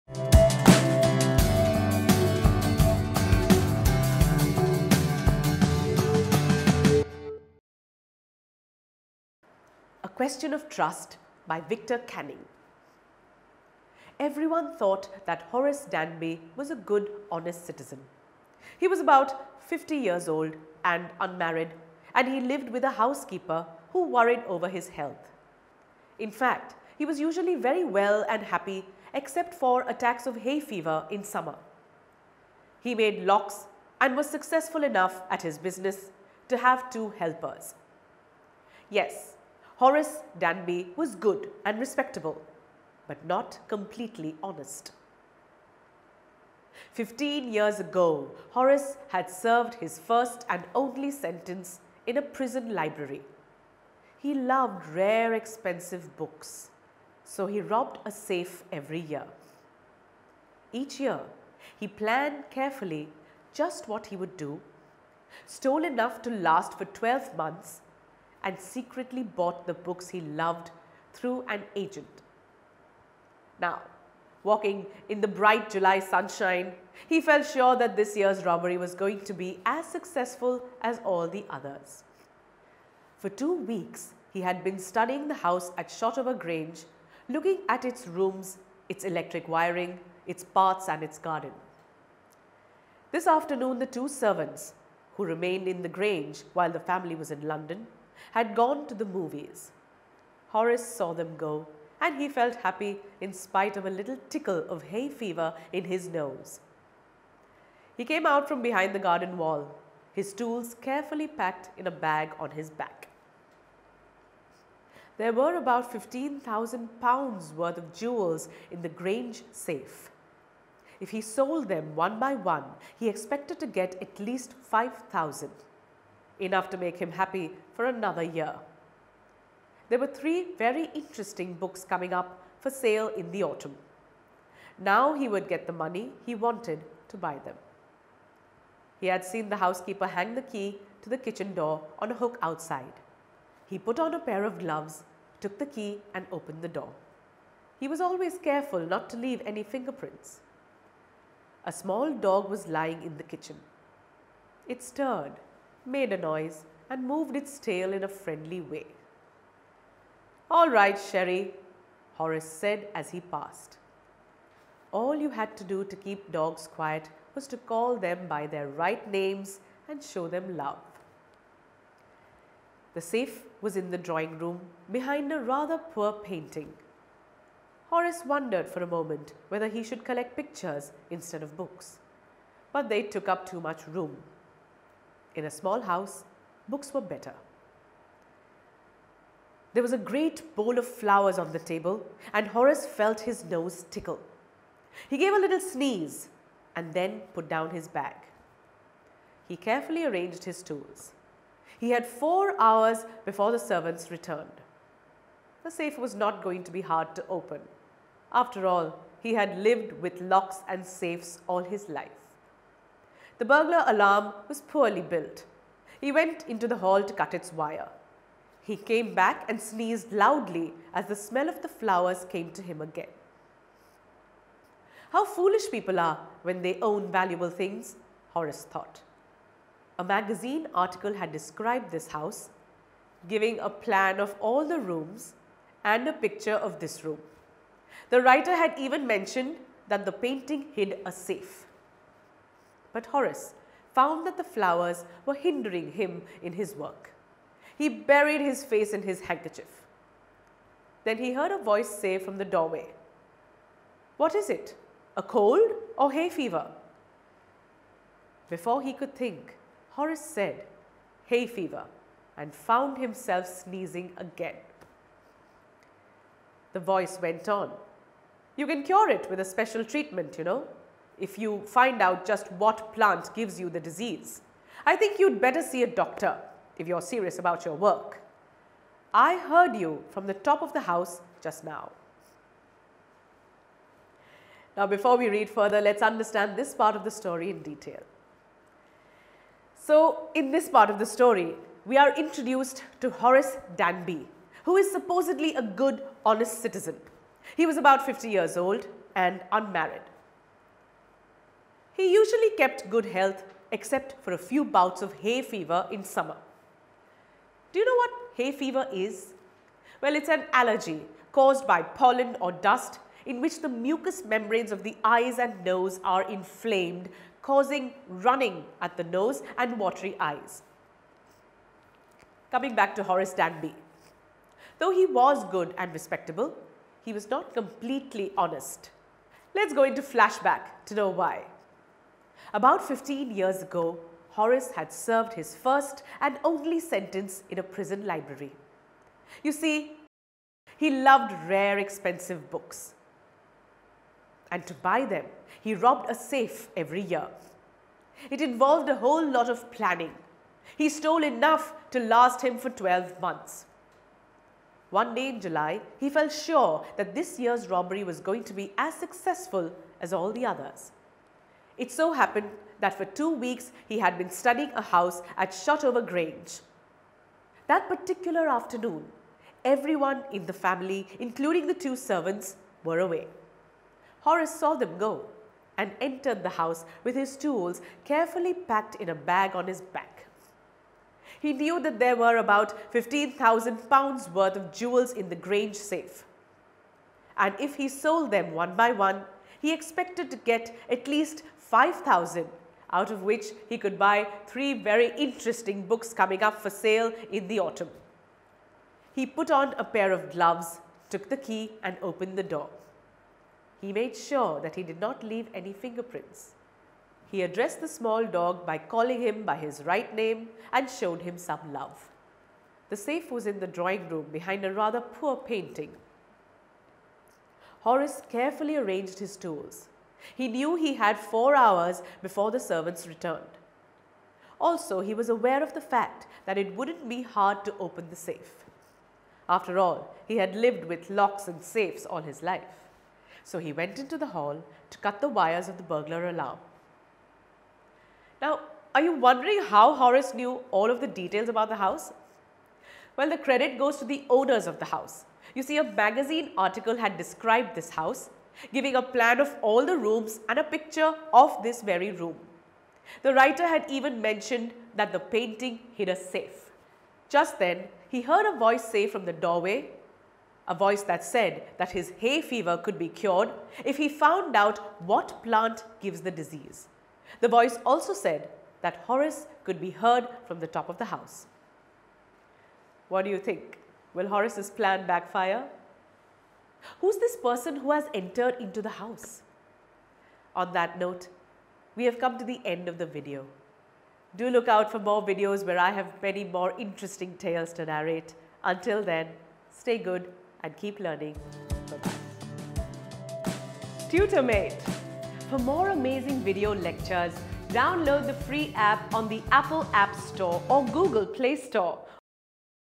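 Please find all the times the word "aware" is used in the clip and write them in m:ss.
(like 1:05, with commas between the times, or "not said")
7:05.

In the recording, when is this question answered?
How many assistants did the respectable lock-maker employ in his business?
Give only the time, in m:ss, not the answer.
0:36.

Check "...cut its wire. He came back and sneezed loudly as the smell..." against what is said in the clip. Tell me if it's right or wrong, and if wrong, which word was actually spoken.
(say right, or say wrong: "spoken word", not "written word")
right.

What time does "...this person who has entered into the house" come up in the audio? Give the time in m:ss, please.
7:57.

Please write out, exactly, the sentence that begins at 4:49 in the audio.
So, in this part of the story, we are introduced to Horace Danby, who is supposedly a good, honest citizen.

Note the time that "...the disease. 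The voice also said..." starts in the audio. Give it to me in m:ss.
7:46.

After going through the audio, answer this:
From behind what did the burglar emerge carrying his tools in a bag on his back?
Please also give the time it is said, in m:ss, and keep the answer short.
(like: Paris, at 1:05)
garden wall, at 1:49.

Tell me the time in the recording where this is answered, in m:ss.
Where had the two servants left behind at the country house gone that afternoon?
1:38.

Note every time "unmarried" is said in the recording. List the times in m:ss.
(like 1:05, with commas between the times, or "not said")
0:21, 4:59.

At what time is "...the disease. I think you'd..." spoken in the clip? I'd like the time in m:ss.
4:33.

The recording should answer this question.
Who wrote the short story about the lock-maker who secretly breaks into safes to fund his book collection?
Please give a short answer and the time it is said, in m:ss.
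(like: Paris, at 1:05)
Victor Canning, at 0:11.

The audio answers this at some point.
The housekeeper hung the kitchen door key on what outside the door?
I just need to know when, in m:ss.
2:22.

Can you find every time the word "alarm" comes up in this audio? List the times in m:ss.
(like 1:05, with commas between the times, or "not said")
3:33, 7:16.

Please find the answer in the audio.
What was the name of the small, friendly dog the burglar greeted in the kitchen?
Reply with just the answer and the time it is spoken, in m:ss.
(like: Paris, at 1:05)
Sherry, at 2:40.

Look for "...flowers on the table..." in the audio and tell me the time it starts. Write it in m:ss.
3:10.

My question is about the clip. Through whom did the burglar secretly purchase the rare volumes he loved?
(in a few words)
an agent.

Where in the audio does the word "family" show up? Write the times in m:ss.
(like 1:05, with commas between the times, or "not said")
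1:36, 6:10.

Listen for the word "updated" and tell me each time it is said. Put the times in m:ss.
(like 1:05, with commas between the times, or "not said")
not said.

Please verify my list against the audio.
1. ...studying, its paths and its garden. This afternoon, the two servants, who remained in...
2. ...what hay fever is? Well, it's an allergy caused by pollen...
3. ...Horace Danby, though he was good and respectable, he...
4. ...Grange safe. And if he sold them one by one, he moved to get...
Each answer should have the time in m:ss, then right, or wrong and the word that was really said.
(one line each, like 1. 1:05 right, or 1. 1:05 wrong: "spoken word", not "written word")
1. 1:29 wrong: "wiring", not "studying"
2. 5:08 right
3. 5:23 right
4. 6:25 wrong: "expected", not "moved".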